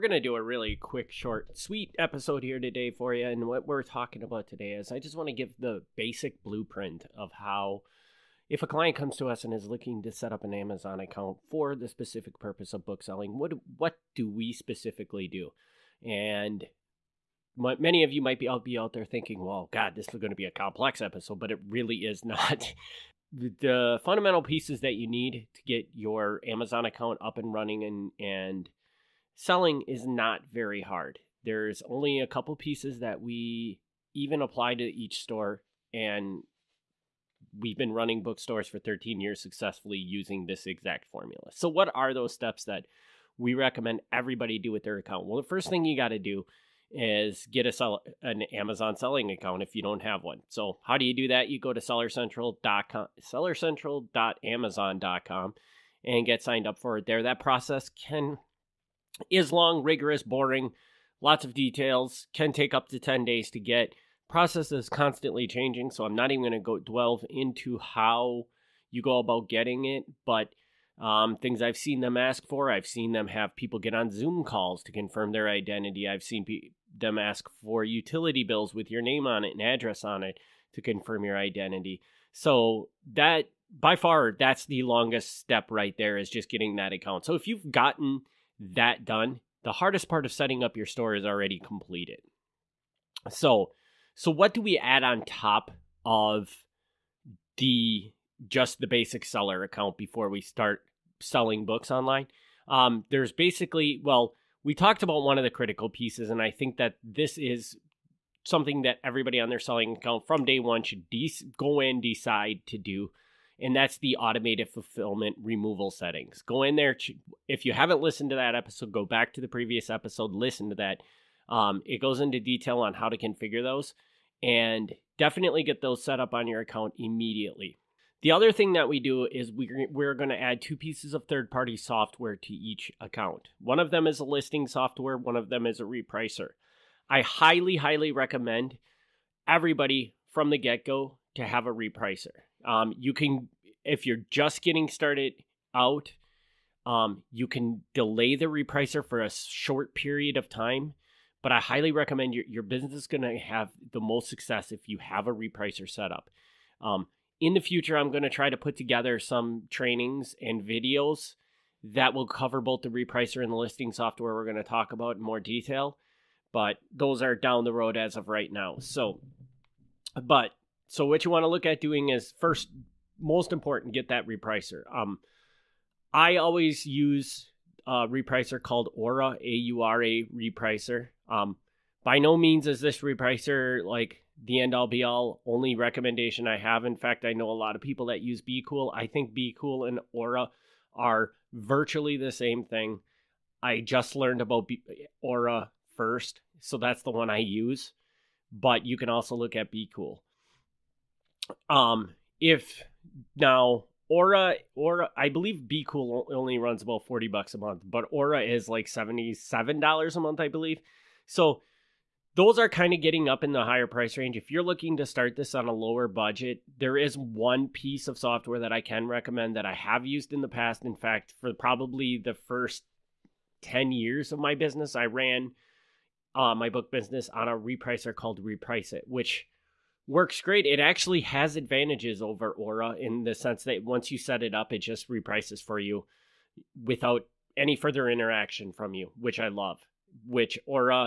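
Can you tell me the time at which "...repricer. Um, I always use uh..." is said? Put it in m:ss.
2:54.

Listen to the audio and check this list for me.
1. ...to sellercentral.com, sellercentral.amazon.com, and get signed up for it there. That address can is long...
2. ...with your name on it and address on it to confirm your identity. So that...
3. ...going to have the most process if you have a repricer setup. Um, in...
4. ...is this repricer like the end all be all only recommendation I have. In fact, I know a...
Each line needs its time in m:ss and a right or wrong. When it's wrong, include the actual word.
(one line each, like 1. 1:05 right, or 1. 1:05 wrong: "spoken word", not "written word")
1. 0:51 wrong: "process", not "address"
2. 1:18 right
3. 2:33 wrong: "success", not "process"
4. 3:02 right.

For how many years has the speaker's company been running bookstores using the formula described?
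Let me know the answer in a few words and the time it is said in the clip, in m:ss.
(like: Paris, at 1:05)
13, at 0:38.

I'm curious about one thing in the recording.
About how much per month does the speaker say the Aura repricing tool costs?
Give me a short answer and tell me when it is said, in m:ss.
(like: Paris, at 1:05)
$77, at 3:28.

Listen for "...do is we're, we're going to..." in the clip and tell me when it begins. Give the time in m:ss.
2:09.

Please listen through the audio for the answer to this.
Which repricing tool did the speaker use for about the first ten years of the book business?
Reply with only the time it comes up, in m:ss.
3:48.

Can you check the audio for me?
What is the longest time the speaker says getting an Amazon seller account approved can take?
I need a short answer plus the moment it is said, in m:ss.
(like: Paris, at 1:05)
10 days, at 1:02.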